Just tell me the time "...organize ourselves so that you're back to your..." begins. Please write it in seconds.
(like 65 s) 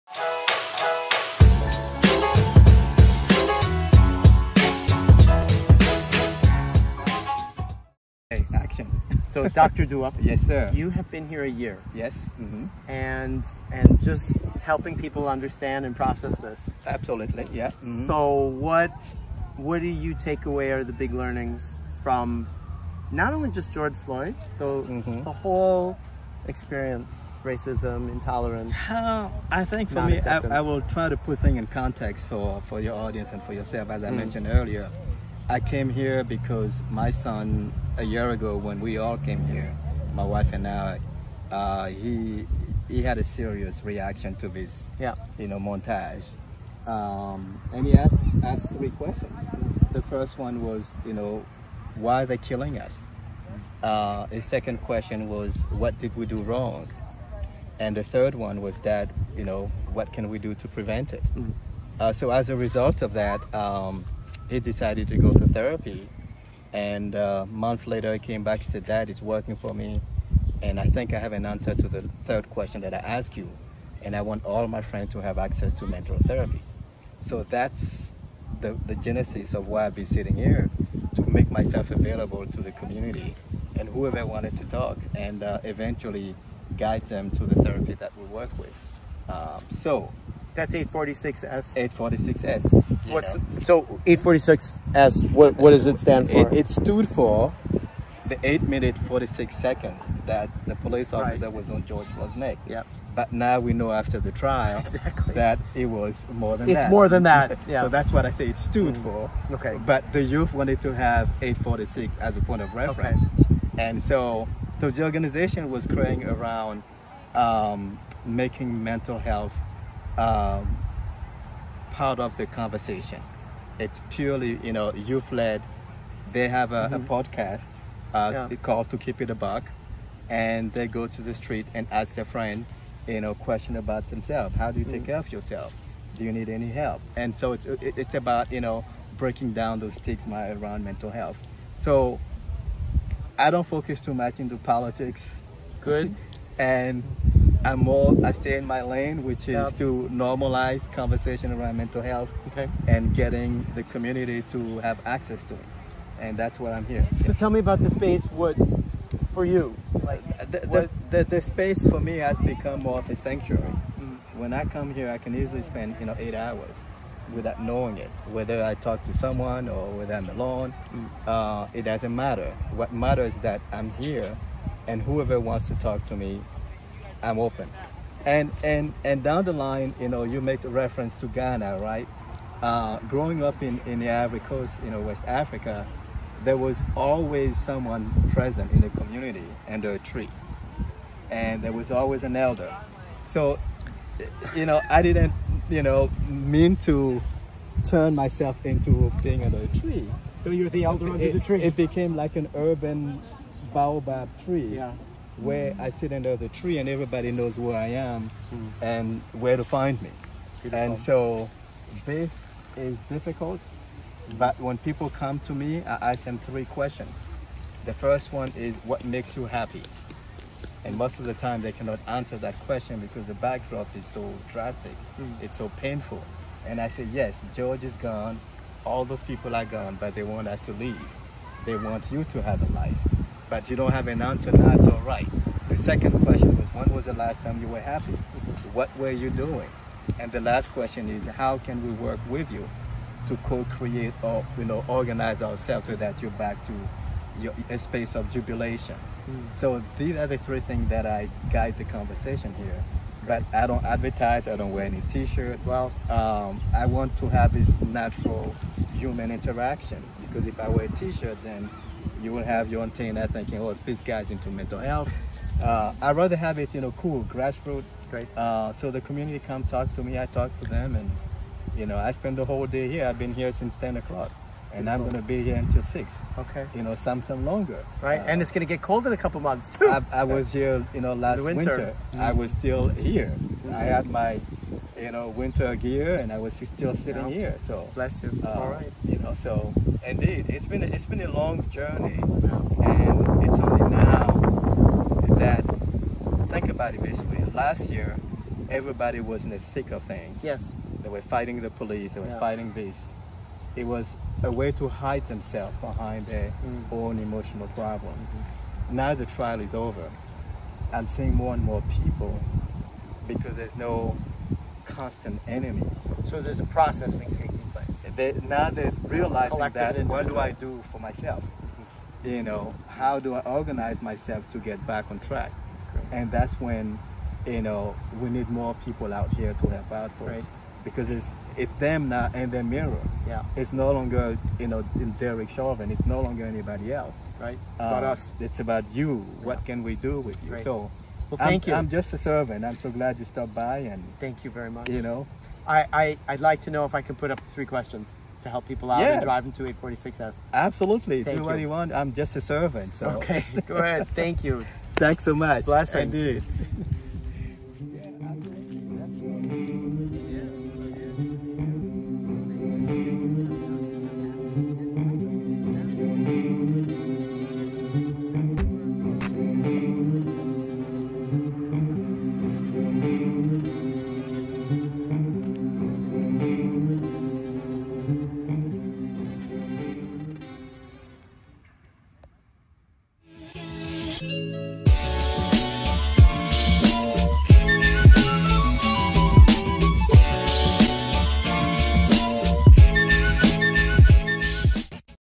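244 s.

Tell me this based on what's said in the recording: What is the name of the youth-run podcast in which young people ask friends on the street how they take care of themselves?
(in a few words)
To Keep It a Buck.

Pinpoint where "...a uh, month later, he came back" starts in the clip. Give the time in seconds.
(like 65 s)
67 s.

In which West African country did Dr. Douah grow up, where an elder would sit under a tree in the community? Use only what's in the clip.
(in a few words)
Ivory Coast.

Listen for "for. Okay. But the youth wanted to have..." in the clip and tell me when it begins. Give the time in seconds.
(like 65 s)
109 s.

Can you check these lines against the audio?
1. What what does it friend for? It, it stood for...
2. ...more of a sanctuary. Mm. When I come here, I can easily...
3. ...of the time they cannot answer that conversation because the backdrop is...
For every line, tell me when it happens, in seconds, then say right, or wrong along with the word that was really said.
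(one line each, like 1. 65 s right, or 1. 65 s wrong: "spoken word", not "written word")
1. 95 s wrong: "stand", not "friend"
2. 162 s right
3. 221 s wrong: "question", not "conversation".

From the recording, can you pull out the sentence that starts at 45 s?
you know, montage, um, and he asked asked three questions.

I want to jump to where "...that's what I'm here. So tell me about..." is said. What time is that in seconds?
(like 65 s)
156 s.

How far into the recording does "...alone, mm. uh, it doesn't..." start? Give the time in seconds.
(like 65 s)
170 s.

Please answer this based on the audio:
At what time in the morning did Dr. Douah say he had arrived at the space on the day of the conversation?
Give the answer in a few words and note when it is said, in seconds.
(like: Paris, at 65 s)
10 o'clock, at 273 s.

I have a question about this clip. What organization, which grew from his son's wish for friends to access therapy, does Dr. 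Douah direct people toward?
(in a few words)
846S.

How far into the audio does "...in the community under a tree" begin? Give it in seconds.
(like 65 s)
188 s.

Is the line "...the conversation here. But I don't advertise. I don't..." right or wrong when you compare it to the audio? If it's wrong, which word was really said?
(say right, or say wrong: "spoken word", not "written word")
right.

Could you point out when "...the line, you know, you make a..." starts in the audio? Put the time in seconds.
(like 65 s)
179 s.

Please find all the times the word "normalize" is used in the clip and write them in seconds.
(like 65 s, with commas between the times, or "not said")
150 s.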